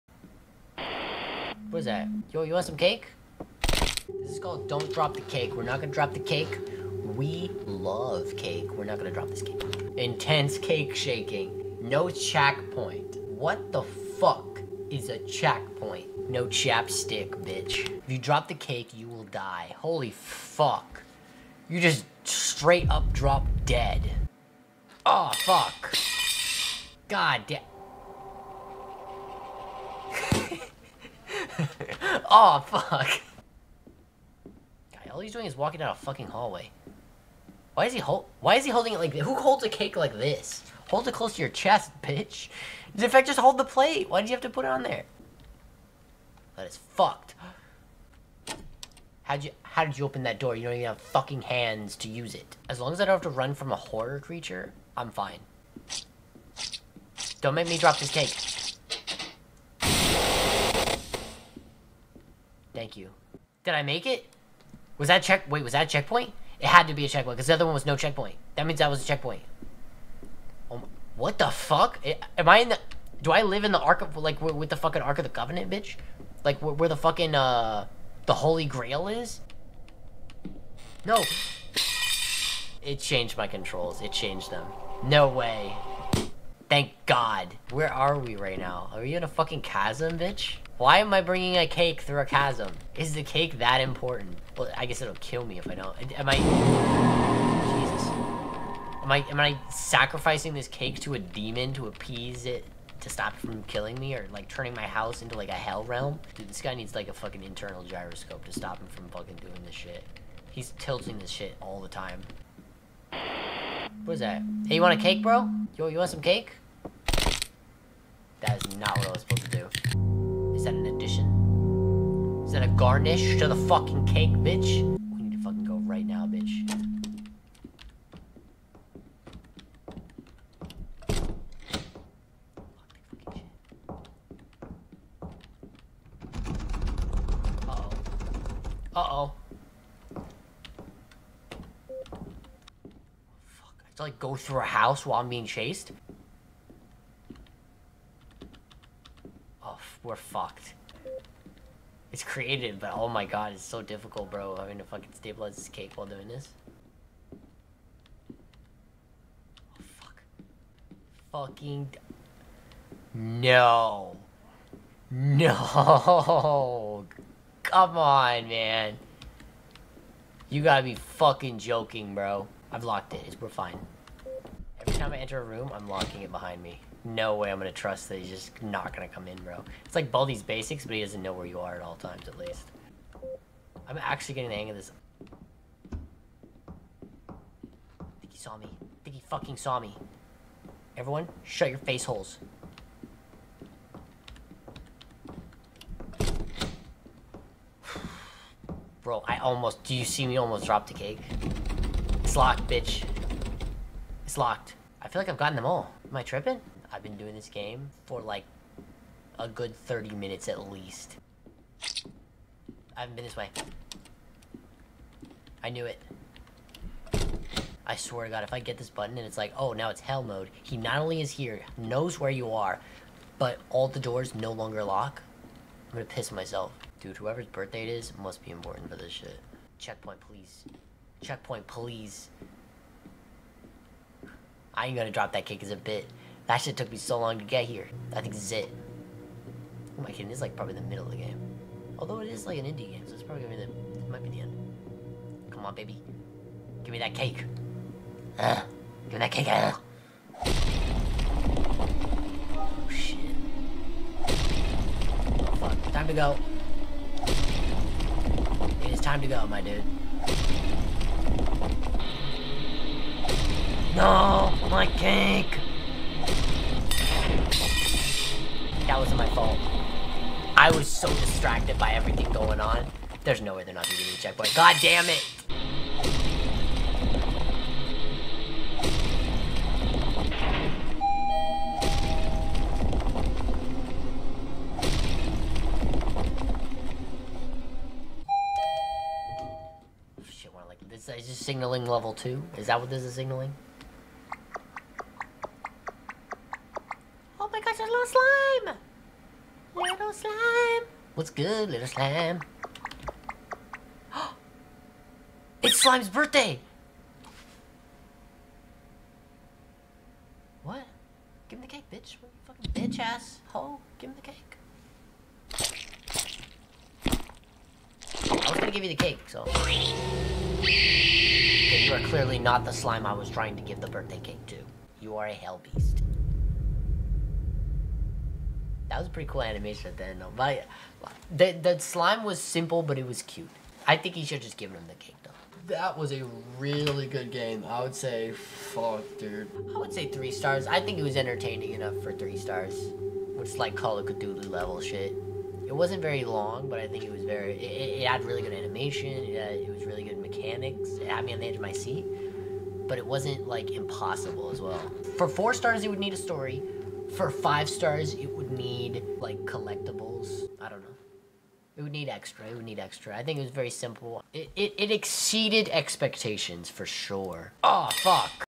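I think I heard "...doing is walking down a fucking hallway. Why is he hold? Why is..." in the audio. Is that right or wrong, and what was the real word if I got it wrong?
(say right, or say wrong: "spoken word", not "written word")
right.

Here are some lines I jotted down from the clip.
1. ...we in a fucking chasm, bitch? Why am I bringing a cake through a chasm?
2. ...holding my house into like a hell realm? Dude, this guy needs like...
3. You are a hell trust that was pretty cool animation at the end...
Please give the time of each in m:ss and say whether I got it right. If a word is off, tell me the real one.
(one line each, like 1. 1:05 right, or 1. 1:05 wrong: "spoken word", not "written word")
1. 1:29 right
2. 1:44 wrong: "turning", not "holding"
3. 5:24 wrong: "beast", not "trust".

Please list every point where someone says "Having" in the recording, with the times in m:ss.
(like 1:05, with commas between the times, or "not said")
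2:34.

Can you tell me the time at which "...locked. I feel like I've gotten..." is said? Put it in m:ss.
3:24.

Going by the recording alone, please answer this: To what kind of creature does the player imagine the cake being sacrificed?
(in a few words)
a demon.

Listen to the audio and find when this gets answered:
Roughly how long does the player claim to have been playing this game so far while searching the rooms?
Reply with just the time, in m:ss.
3:29.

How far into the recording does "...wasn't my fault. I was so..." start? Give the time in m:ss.
4:28.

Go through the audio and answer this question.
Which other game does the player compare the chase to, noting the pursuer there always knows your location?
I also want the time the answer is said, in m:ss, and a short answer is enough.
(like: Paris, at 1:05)
Baldi's Basics, at 3:00.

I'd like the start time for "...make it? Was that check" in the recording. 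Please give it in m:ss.
1:03.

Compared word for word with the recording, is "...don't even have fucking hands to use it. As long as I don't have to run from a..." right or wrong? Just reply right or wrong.
right.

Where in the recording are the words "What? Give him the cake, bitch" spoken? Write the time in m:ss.
5:10.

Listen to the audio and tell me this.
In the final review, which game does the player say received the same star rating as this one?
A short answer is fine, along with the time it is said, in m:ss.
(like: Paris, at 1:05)
Call of Cthulhu, at 5:43.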